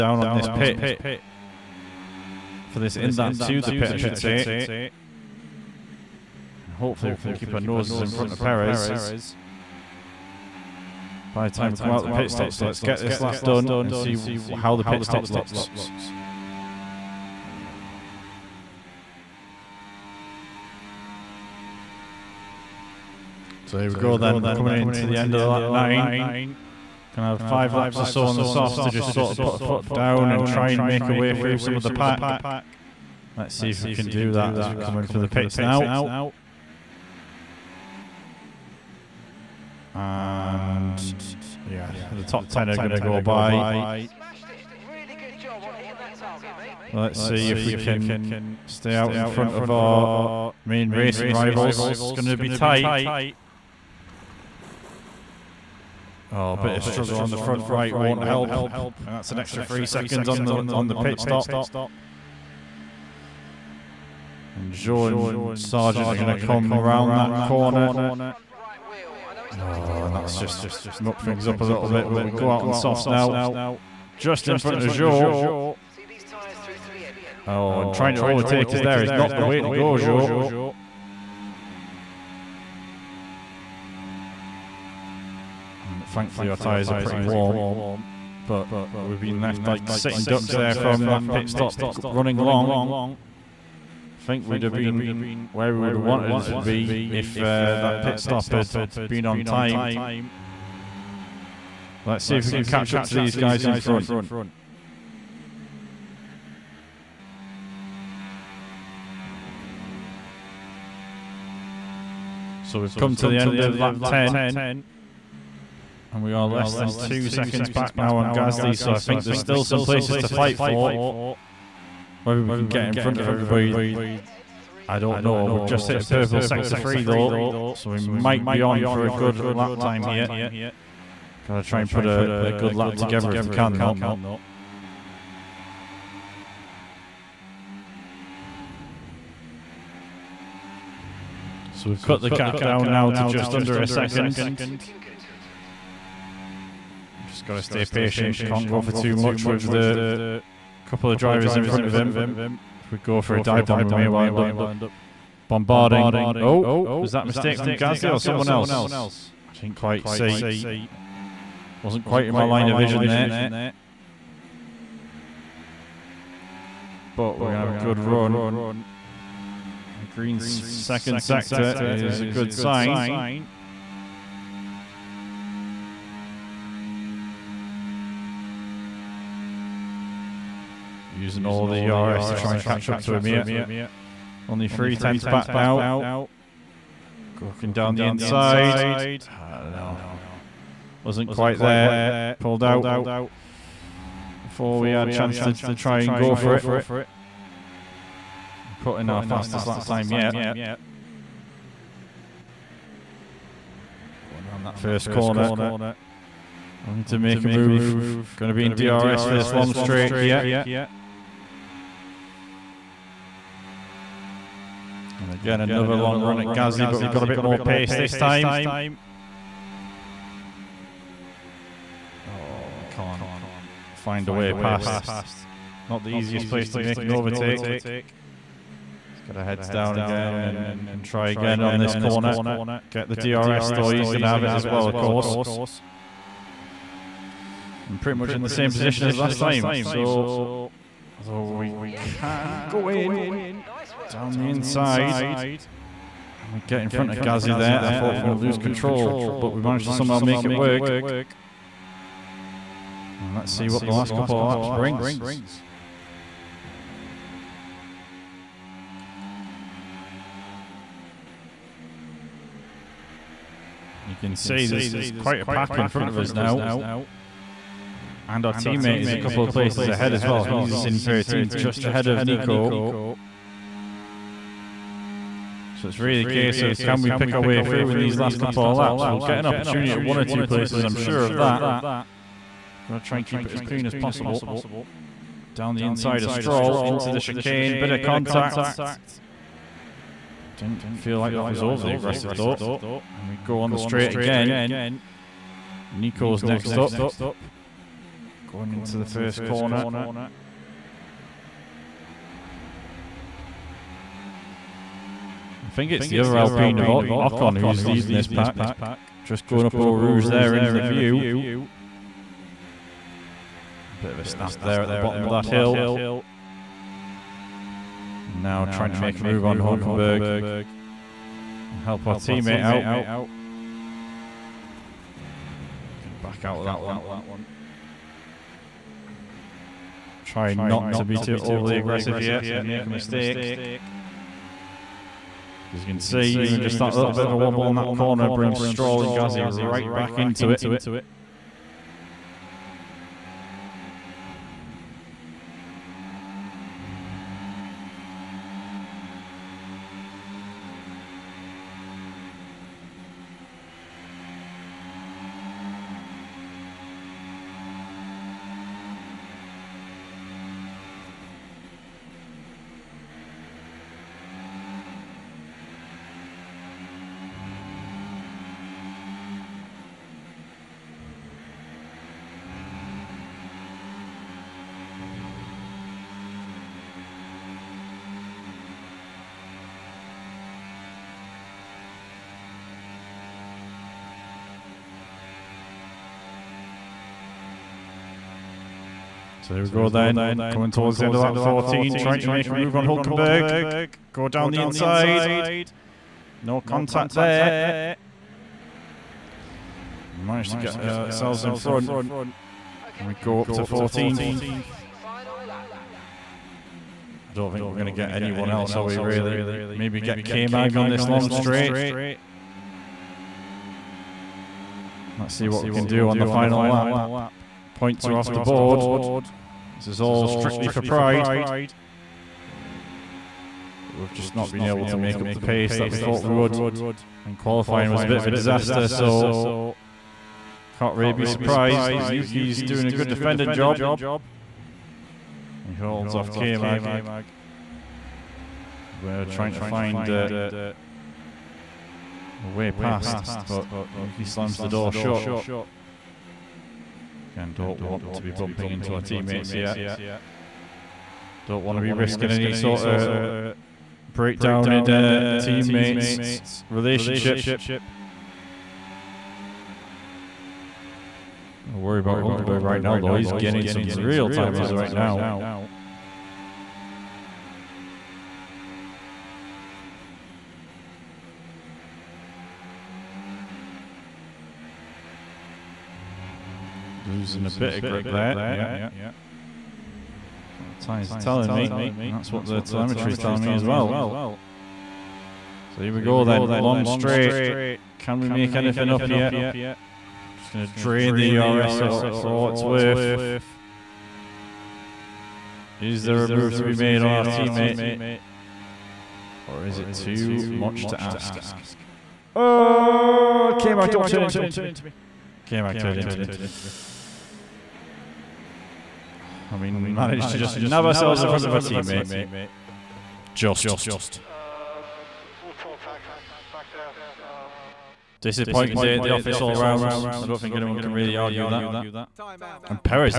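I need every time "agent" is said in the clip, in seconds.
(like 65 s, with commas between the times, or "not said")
not said.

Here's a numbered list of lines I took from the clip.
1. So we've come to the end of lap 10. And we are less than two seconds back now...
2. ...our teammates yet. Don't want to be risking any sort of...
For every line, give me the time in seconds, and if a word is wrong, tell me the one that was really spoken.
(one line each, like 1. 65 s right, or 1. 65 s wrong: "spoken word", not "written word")
1. 112 s right
2. 448 s right.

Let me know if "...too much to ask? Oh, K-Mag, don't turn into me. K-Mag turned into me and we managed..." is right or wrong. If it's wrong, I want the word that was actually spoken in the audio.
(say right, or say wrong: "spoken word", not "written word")
right.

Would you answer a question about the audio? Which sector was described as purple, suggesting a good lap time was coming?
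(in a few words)
Sector 3.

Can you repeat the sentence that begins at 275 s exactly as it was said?
So it's really a case of can we pick our way through in these last couple of laps?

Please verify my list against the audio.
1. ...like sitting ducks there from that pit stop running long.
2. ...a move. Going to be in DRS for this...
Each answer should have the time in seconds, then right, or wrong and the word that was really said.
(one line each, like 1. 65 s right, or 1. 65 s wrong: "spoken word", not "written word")
1. 89 s right
2. 207 s right.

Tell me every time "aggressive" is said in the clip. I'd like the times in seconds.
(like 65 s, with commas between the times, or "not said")
291 s, 331 s.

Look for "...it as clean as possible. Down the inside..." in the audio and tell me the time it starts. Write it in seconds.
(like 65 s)
283 s.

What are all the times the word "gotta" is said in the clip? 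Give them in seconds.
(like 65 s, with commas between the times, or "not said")
131 s, 147 s.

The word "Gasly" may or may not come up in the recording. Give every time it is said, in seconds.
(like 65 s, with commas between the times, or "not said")
118 s, 157 s, 216 s, 247 s, 339 s.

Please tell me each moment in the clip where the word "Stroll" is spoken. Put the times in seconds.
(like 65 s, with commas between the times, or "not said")
286 s, 338 s.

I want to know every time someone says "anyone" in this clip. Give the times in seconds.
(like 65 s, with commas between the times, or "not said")
408 s, 520 s.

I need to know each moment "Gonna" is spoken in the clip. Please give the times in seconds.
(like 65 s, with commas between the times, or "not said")
27 s, 282 s.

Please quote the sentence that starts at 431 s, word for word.
But Yuki's doing a good defending job.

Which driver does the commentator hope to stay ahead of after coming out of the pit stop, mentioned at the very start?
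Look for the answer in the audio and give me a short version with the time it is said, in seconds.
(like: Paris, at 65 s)
Perez, at 8 s.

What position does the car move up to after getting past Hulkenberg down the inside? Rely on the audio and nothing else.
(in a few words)
14th.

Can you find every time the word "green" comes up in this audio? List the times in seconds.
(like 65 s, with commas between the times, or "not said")
170 s.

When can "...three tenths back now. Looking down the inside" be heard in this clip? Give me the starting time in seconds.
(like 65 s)
184 s.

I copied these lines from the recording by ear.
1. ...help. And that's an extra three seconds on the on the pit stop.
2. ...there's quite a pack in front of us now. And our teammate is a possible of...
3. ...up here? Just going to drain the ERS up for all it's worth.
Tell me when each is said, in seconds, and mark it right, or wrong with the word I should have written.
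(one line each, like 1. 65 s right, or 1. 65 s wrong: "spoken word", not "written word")
1. 58 s right
2. 264 s wrong: "couple", not "possible"
3. 488 s right.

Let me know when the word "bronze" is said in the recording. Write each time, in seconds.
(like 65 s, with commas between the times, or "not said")
not said.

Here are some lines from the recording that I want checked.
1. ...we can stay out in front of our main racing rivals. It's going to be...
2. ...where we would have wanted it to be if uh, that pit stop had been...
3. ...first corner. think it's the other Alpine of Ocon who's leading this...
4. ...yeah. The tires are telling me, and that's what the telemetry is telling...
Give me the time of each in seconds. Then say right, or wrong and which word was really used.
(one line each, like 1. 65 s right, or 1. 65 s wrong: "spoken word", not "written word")
1. 47 s right
2. 95 s right
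3. 299 s right
4. 478 s right.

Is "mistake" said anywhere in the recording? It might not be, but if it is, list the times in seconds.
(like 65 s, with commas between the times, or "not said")
157 s, 332 s.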